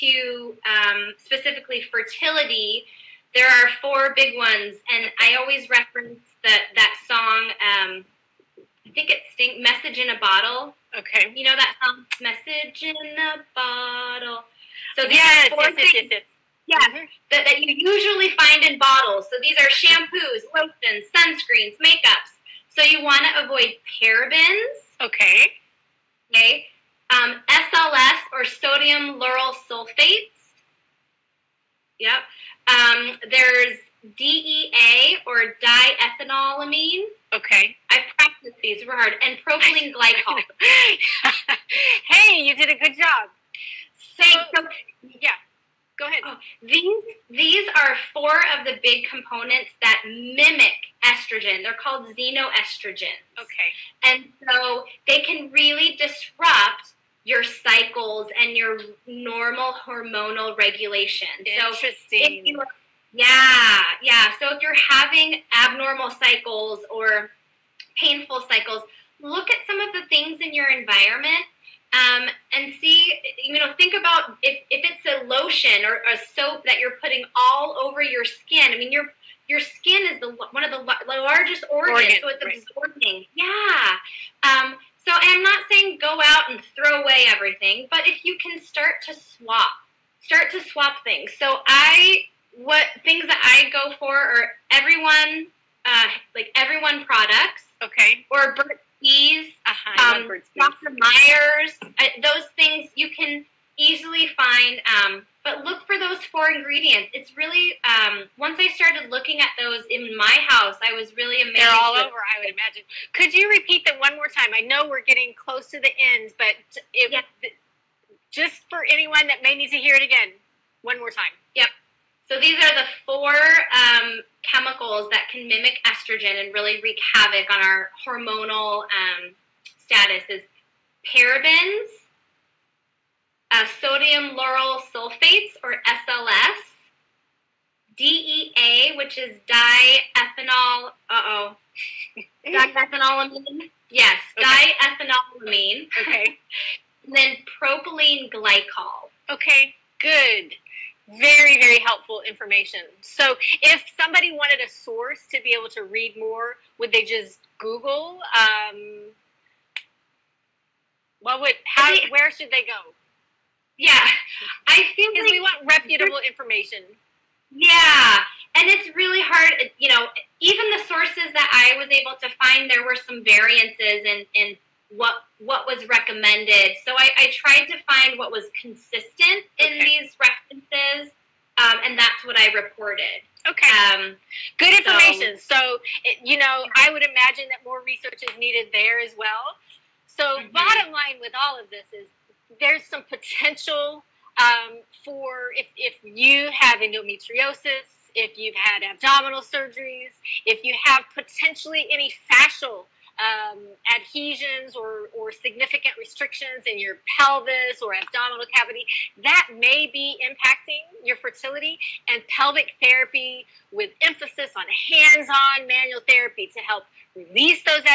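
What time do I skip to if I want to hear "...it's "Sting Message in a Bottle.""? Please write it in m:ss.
0:09.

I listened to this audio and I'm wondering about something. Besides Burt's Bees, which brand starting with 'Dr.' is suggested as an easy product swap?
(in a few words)
Dr. Myers.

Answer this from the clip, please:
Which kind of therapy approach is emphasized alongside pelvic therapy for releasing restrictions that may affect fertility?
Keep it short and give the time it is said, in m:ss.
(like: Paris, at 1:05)
hands-on manual therapy, at 3:34.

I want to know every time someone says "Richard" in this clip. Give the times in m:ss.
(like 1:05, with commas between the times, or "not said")
not said.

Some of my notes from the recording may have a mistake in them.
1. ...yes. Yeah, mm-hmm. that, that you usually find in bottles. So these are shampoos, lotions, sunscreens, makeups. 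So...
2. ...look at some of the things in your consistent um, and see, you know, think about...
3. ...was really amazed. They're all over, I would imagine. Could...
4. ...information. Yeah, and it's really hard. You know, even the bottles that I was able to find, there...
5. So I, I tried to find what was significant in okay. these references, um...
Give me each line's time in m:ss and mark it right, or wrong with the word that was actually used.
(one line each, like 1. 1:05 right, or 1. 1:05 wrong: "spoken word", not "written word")
1. 0:16 right
2. 1:09 wrong: "environment", not "consistent"
3. 1:50 right
4. 2:46 wrong: "sources", not "bottles"
5. 2:56 wrong: "consistent", not "significant".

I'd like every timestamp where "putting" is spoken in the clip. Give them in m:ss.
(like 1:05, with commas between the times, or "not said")
1:17.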